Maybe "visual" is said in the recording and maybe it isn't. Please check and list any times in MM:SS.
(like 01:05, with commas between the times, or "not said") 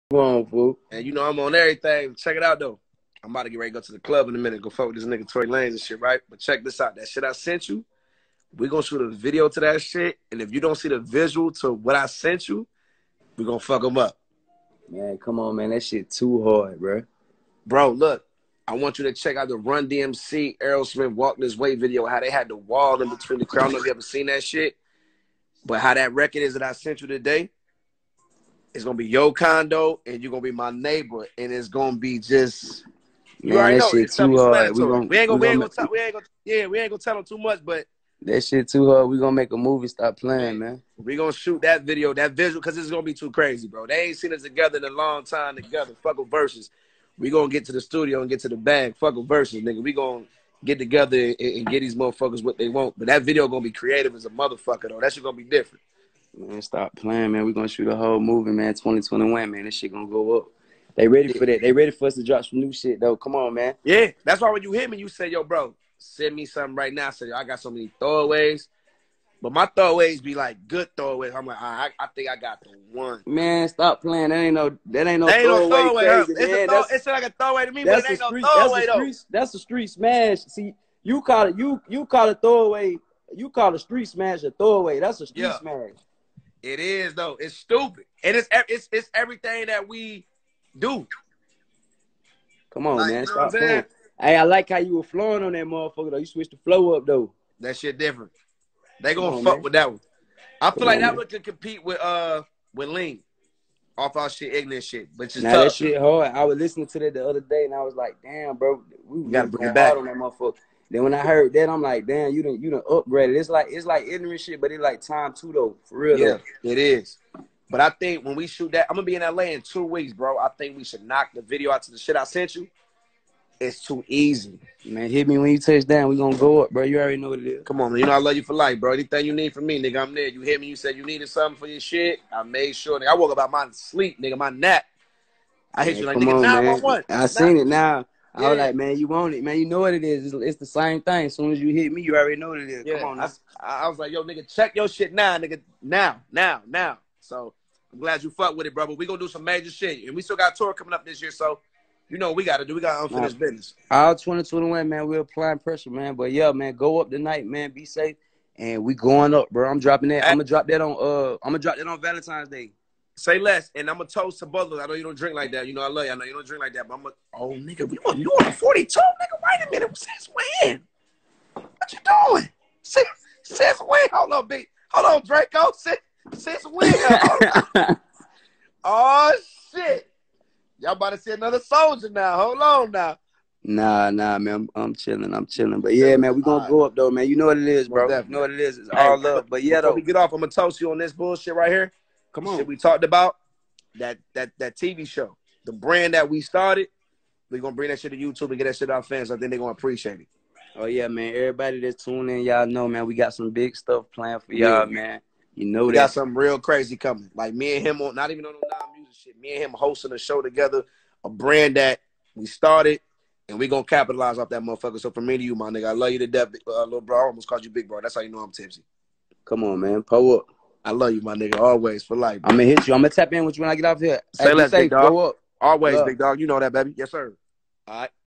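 00:10, 00:42.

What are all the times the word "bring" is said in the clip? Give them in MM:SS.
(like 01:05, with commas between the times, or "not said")
01:49, 03:17.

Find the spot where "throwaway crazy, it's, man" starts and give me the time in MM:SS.
01:15.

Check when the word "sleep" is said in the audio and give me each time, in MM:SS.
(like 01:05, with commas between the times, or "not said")
02:13.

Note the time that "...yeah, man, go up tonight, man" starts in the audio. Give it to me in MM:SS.
02:36.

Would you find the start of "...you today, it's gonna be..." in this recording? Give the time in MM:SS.
00:27.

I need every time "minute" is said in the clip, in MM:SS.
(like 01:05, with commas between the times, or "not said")
00:04, 02:49.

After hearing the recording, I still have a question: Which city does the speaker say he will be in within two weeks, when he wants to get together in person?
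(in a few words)
LA.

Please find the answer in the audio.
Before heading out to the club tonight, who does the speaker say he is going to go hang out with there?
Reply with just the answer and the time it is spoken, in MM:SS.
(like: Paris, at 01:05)
Tory Lanez, at 00:05.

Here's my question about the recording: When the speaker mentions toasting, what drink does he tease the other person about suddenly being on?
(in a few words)
42.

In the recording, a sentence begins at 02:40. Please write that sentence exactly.
Uh, I'm gonna drop that on Valentine's Day.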